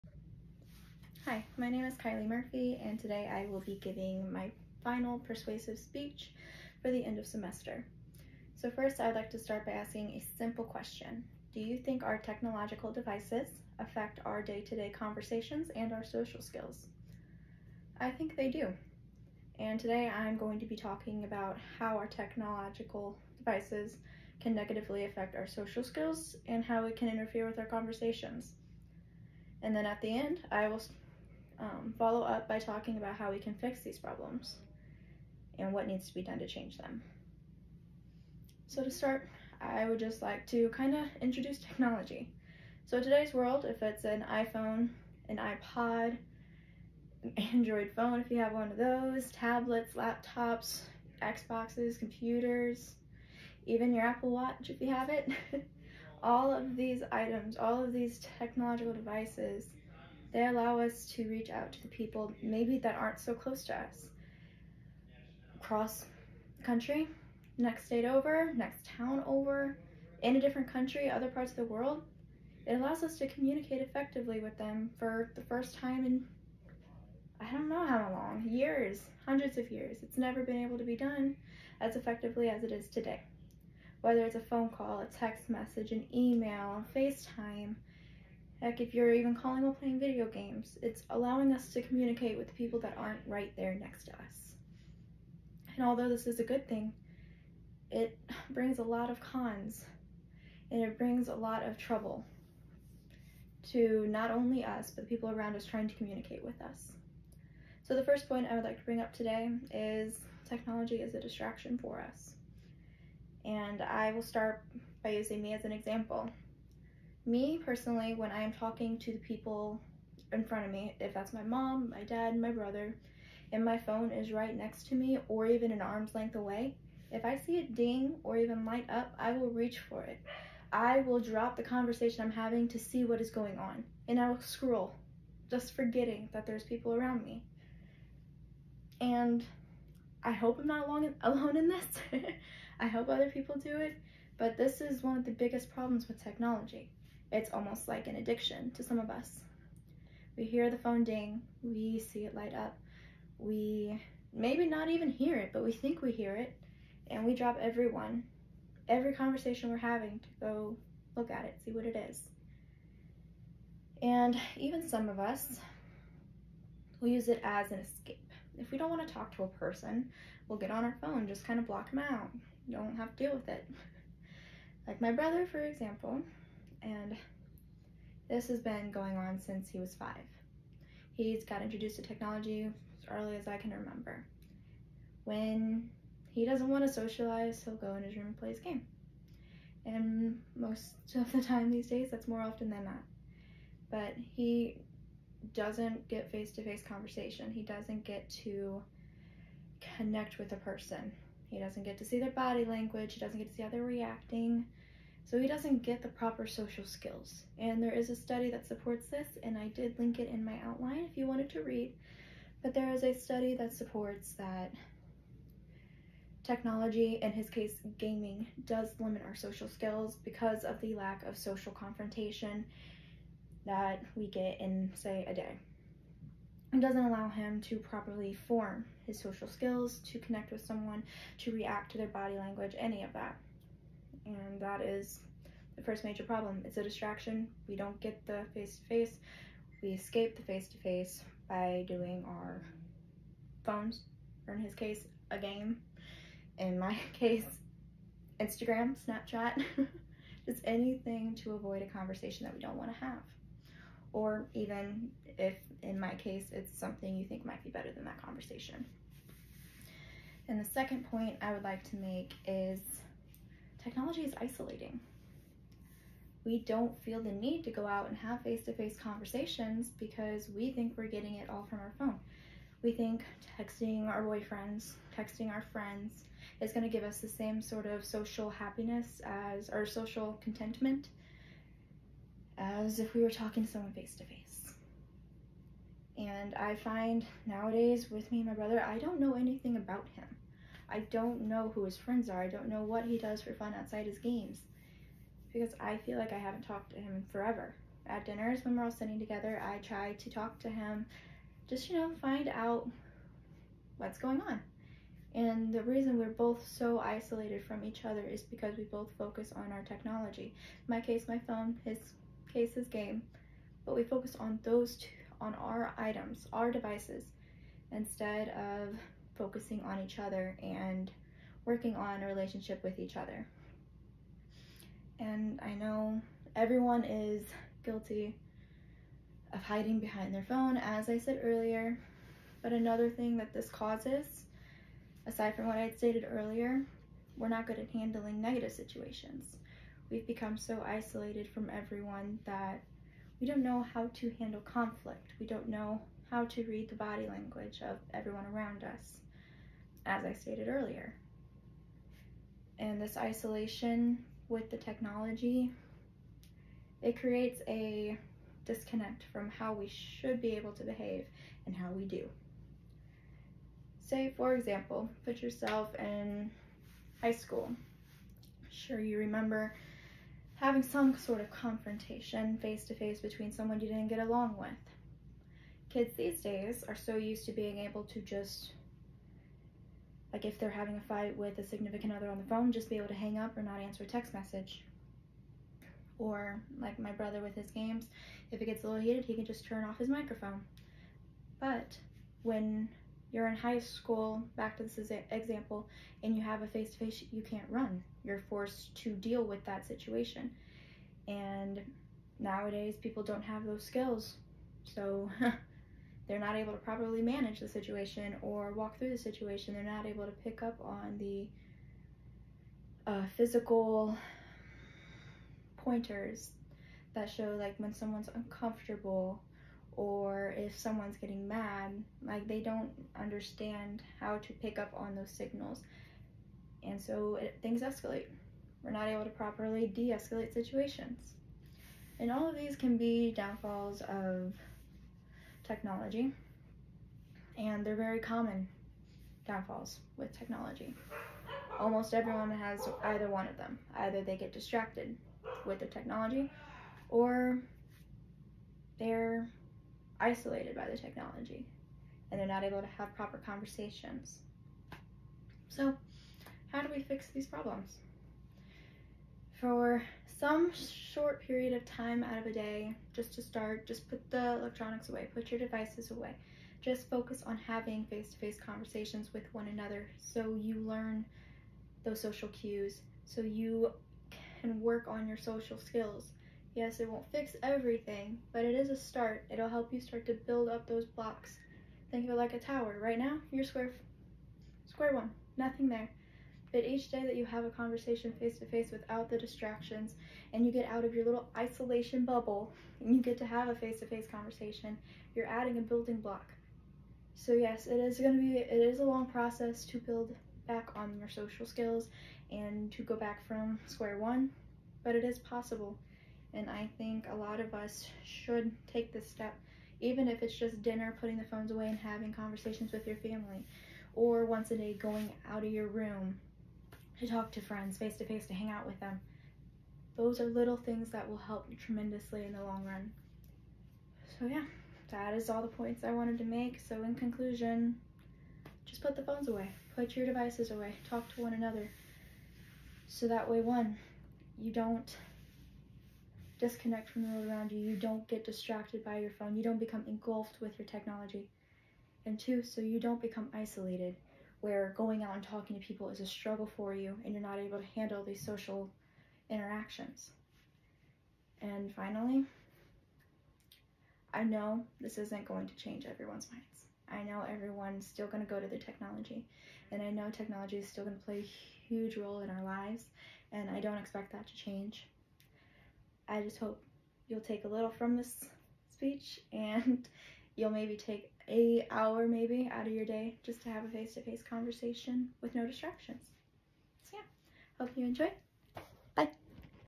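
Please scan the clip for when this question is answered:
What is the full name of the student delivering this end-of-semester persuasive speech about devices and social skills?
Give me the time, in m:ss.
0:01.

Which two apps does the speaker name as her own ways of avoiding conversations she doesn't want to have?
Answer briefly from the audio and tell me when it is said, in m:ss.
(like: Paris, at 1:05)
Instagram, Snapchat, at 4:08.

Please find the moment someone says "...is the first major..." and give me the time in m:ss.
3:54.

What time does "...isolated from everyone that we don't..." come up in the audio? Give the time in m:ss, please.
5:40.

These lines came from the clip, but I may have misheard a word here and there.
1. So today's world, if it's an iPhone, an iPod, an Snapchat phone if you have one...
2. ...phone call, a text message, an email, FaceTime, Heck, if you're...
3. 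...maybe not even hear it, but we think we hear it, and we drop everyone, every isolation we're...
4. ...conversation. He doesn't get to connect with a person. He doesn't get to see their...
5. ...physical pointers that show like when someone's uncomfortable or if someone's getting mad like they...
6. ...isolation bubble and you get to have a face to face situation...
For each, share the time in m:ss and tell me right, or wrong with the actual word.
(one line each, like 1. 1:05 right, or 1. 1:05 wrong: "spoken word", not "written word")
1. 0:42 wrong: "Android", not "Snapchat"
2. 1:24 right
3. 2:34 wrong: "conversation", not "isolation"
4. 3:16 right
5. 6:53 right
6. 8:11 wrong: "conversation", not "situation".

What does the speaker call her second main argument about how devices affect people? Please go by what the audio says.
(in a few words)
Technology is isolating.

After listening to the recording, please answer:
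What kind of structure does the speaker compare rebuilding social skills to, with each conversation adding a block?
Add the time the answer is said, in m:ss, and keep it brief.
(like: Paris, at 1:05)
a tower, at 8:02.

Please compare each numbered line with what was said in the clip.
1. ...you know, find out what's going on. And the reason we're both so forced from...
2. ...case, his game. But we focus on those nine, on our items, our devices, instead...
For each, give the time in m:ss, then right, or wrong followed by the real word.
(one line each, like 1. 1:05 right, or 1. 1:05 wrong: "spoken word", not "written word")
1. 5:01 wrong: "isolated", not "forced"
2. 5:12 wrong: "two", not "nine".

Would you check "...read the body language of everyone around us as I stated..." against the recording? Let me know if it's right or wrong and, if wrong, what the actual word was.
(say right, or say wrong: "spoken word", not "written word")
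right.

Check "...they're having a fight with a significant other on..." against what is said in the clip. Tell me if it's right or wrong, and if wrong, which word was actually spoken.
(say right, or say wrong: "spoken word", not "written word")
right.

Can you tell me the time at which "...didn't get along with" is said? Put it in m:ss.
6:13.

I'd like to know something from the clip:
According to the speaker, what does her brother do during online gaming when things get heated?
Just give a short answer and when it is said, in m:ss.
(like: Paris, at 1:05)
turn off his microphone, at 6:29.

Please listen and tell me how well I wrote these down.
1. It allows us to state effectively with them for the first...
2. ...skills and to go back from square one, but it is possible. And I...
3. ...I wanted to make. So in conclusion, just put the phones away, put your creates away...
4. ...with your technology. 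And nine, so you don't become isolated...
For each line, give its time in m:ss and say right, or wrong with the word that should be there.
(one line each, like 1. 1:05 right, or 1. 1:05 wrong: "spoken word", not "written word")
1. 1:12 wrong: "communicate", not "state"
2. 8:21 right
3. 8:46 wrong: "devices", not "creates"
4. 9:00 wrong: "two", not "nine".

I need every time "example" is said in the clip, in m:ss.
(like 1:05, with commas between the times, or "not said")
1:55, 2:55, 6:04, 6:35.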